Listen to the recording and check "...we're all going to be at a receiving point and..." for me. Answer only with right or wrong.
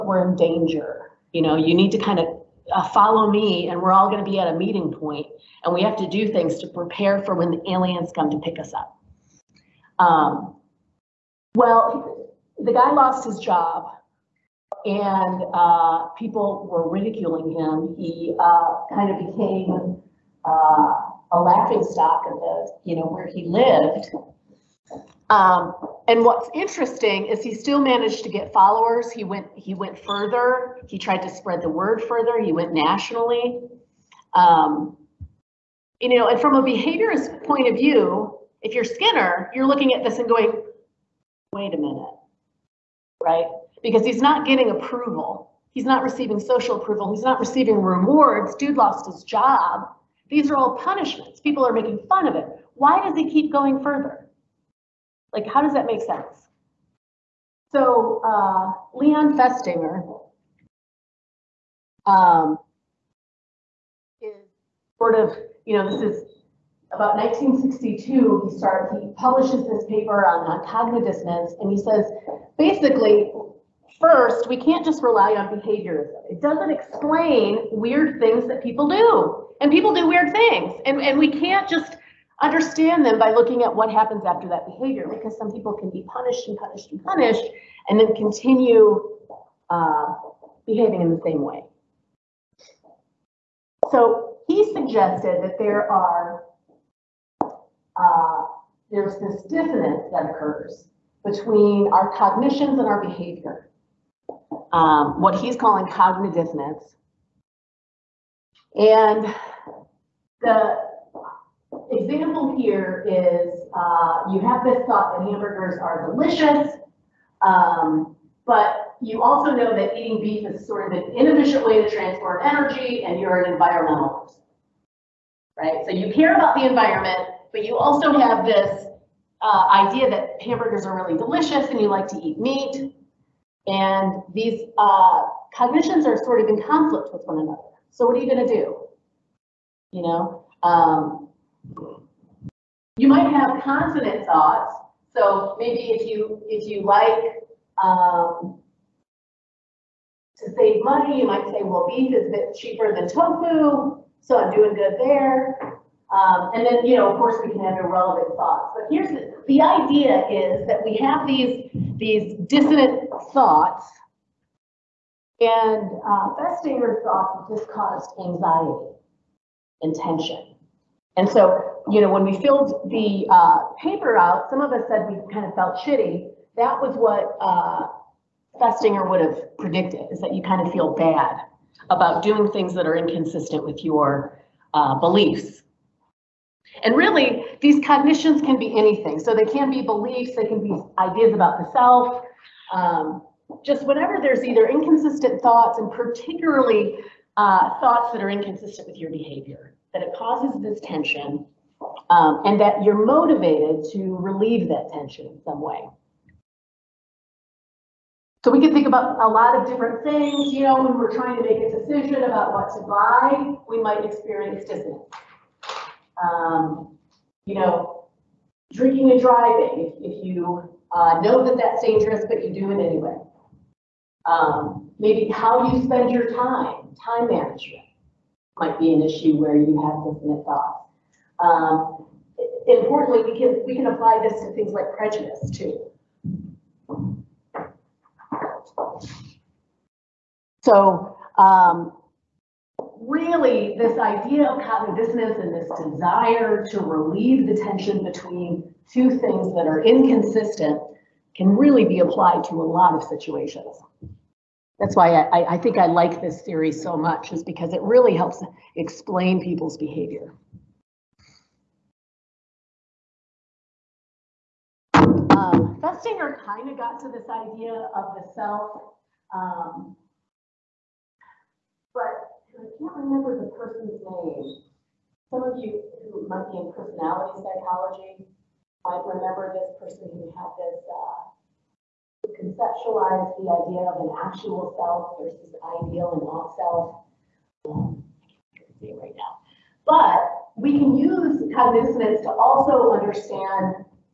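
wrong.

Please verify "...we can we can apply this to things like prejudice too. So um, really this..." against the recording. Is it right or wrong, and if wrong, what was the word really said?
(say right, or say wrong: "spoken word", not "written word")
right.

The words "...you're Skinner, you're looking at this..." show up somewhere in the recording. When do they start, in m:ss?
0:38.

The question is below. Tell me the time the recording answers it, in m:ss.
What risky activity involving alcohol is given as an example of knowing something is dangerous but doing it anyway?
3:38.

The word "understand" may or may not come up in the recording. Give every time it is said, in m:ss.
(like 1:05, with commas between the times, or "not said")
1:22, 4:52.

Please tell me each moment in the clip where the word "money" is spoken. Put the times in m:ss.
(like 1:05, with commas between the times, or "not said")
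2:30.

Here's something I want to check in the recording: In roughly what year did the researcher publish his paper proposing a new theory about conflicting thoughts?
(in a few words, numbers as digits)
1962.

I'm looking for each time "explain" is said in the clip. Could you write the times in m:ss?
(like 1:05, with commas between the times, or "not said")
1:16, 4:18.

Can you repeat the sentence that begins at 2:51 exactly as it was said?
And so, you know, when we filled the uh, paper out, some of us said we kind of felt shitty.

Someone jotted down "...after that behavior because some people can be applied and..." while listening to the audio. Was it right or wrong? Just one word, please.
wrong.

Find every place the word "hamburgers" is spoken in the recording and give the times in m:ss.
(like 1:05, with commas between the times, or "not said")
1:55, 2:10.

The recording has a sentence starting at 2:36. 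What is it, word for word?
Um, and then, you know, of course, we can have irrelevant thoughts.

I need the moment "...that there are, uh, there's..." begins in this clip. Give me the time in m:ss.
1:35.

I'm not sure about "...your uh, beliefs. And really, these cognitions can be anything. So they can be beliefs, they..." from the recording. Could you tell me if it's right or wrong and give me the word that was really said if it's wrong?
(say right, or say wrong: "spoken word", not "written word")
right.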